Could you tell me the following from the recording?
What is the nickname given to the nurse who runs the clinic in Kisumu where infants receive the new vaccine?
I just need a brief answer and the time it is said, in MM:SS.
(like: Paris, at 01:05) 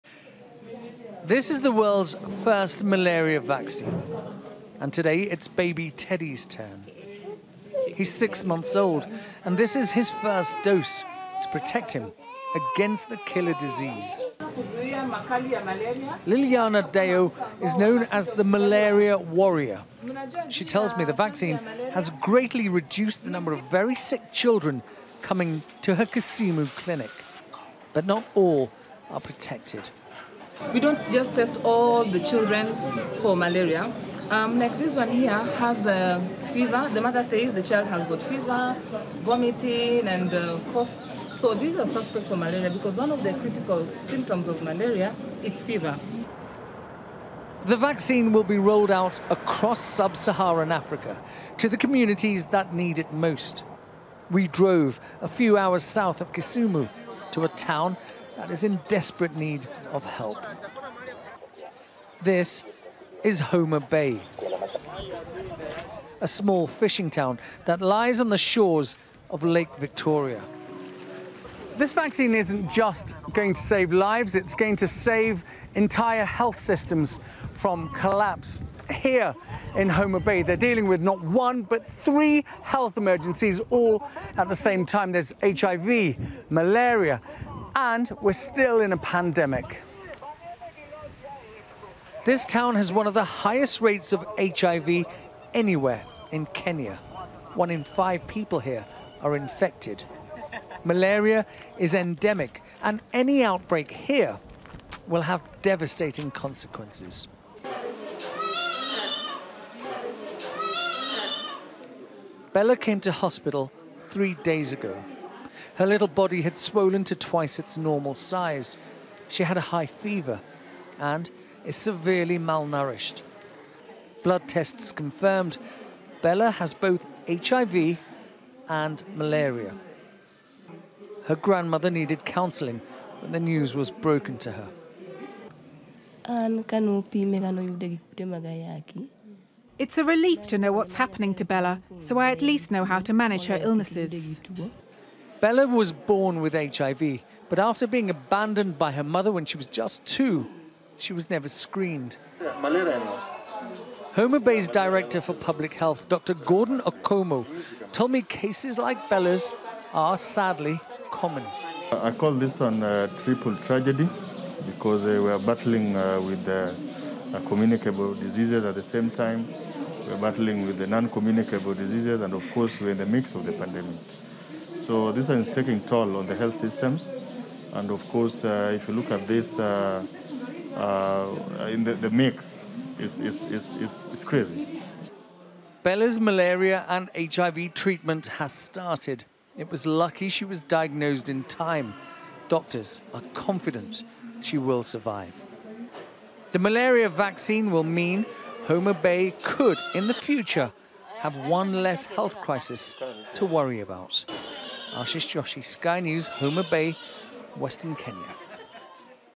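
The malaria warrior, at 00:18.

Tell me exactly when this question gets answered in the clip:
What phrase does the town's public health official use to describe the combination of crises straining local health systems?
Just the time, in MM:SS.
02:43.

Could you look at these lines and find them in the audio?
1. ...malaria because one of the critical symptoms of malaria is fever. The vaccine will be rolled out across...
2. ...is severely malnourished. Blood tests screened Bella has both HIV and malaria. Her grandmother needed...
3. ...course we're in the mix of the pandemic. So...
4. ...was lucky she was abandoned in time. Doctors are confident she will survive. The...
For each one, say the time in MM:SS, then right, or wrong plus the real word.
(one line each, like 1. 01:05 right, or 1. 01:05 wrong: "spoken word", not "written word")
1. 00:42 right
2. 02:01 wrong: "confirmed", not "screened"
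3. 02:52 right
4. 03:09 wrong: "diagnosed", not "abandoned".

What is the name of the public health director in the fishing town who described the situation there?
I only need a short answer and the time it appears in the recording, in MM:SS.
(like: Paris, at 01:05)
Dr. Gordon Okomo, at 02:36.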